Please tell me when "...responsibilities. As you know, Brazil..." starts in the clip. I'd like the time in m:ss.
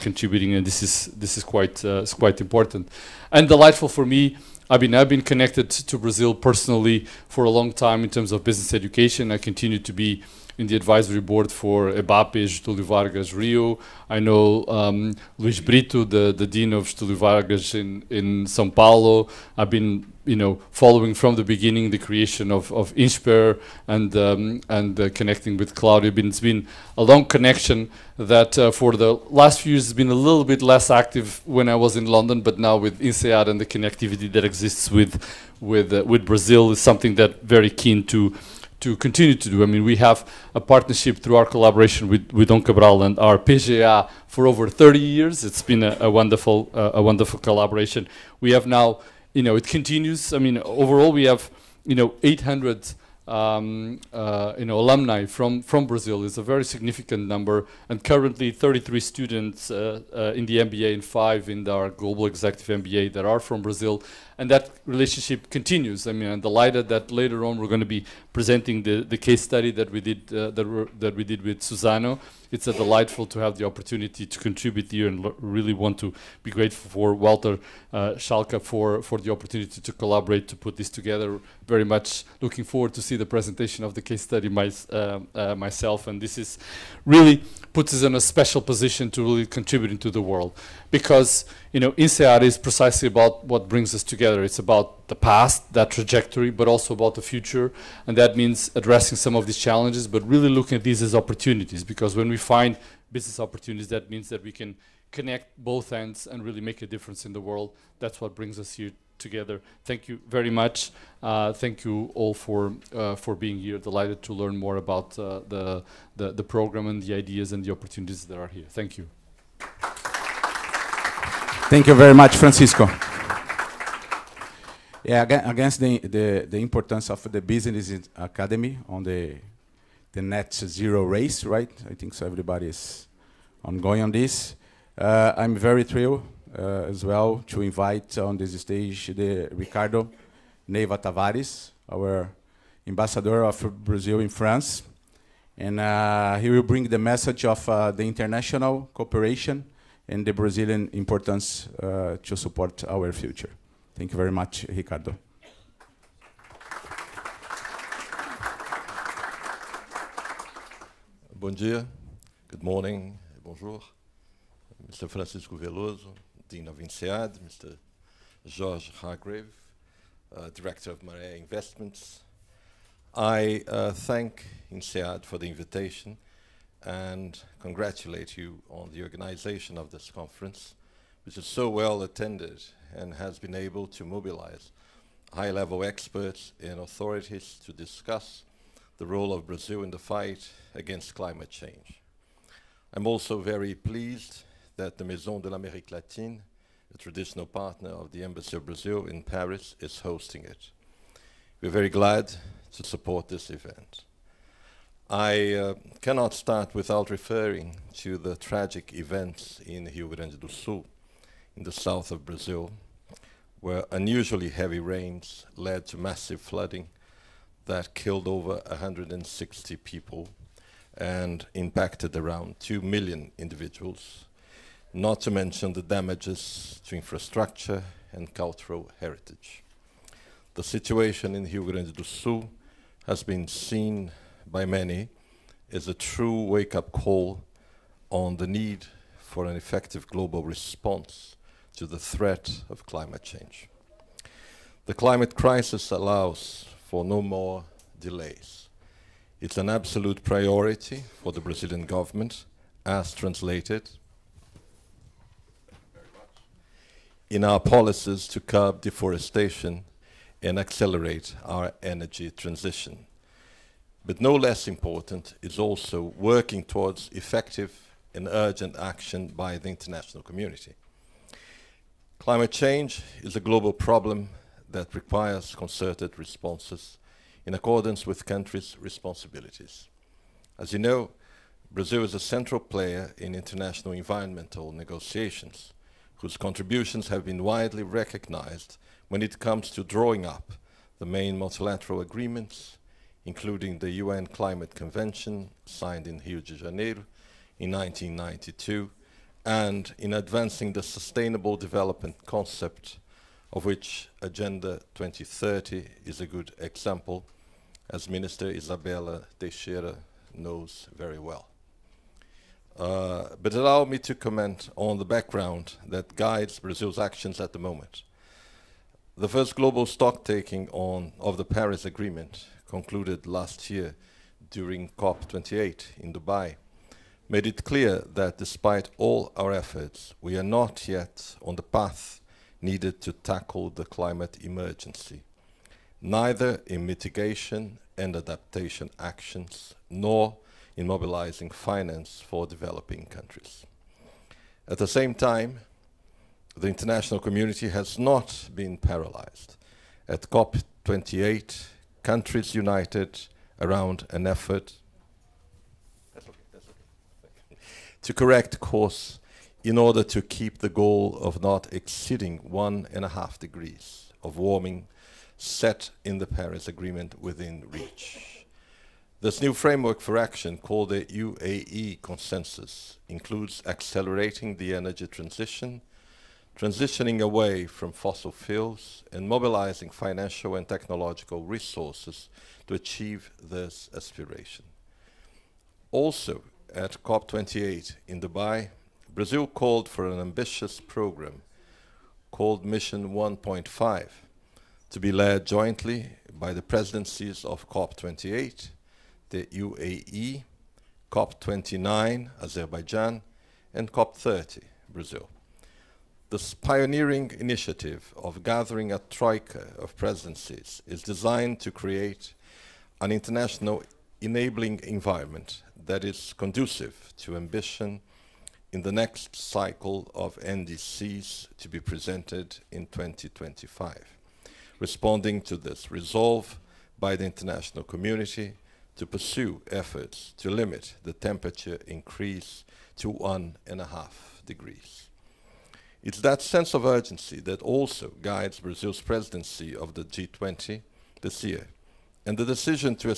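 4:38.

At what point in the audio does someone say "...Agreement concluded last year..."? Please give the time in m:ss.
5:21.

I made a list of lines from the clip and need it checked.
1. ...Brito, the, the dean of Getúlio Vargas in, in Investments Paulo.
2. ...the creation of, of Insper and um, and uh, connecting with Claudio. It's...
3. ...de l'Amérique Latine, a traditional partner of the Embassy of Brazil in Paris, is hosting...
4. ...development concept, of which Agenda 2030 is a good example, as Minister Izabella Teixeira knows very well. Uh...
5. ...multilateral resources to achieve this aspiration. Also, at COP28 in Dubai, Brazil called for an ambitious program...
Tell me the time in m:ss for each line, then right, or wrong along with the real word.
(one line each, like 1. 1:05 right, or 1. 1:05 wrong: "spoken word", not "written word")
1. 0:15 wrong: "São", not "Investments"
2. 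0:21 right
3. 3:15 right
4. 5:01 right
5. 6:20 wrong: "technological", not "multilateral".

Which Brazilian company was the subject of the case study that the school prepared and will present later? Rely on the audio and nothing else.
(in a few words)
Suzano.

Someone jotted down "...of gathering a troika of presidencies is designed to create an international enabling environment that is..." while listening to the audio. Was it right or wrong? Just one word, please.
right.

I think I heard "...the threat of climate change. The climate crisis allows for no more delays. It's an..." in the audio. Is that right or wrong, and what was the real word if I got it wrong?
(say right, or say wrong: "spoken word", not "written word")
right.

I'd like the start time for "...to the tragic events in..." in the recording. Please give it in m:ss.
3:27.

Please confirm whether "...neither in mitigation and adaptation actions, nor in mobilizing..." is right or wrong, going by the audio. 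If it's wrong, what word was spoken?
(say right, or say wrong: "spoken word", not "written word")
right.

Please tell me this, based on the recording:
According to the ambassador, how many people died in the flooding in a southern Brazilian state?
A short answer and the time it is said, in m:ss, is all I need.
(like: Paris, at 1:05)
over 160, at 3:38.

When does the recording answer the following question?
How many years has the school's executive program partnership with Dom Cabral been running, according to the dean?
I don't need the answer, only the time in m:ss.
0:44.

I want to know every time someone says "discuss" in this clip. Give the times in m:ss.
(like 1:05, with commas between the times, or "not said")
3:07.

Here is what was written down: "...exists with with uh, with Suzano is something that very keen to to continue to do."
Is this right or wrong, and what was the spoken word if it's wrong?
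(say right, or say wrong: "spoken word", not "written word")
wrong: "Brazil", not "Suzano".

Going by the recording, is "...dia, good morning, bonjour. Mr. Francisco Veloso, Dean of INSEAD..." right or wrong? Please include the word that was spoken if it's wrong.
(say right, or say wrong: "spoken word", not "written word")
right.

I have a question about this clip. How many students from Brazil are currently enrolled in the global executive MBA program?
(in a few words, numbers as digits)
5.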